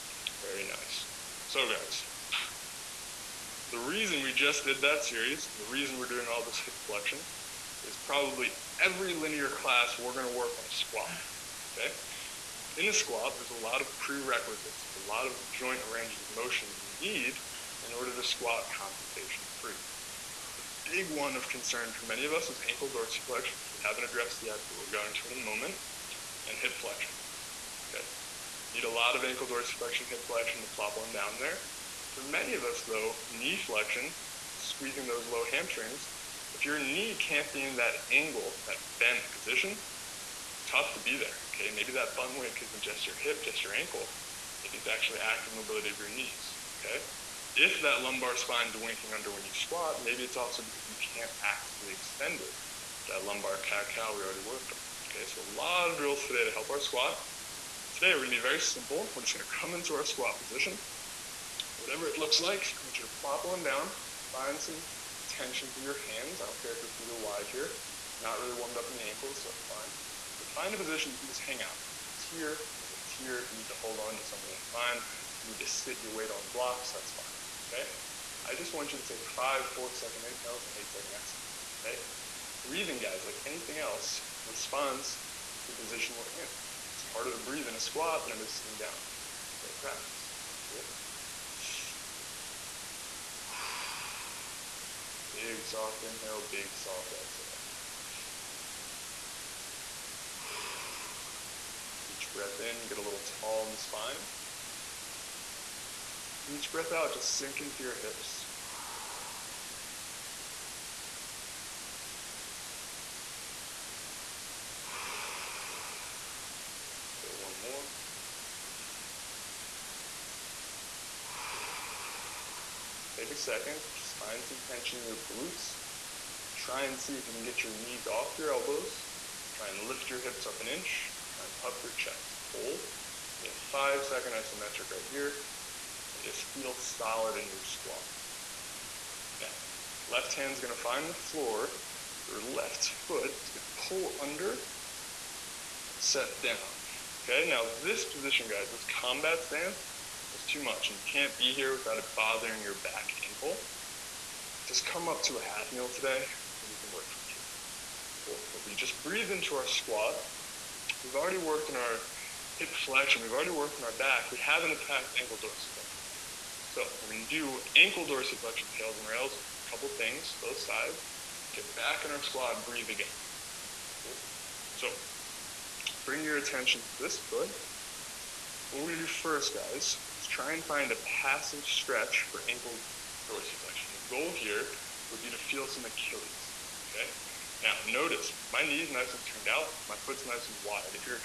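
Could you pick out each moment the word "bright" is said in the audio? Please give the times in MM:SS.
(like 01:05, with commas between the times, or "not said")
not said.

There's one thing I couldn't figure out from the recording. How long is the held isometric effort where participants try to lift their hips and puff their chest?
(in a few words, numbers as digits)
5 seconds.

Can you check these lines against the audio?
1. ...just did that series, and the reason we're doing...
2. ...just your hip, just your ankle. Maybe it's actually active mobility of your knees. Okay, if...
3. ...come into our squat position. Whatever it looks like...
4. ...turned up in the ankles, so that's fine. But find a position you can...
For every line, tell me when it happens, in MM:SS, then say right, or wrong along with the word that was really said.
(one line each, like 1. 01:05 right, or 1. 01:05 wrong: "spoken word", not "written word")
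1. 00:04 right
2. 00:42 right
3. 00:59 right
4. 01:08 wrong: "warmed", not "turned".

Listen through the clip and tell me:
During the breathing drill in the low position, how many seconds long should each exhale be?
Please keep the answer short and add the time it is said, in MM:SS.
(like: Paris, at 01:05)
8, at 01:20.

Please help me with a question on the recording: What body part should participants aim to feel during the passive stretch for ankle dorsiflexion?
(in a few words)
Achilles.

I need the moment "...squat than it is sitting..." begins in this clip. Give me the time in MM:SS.
01:27.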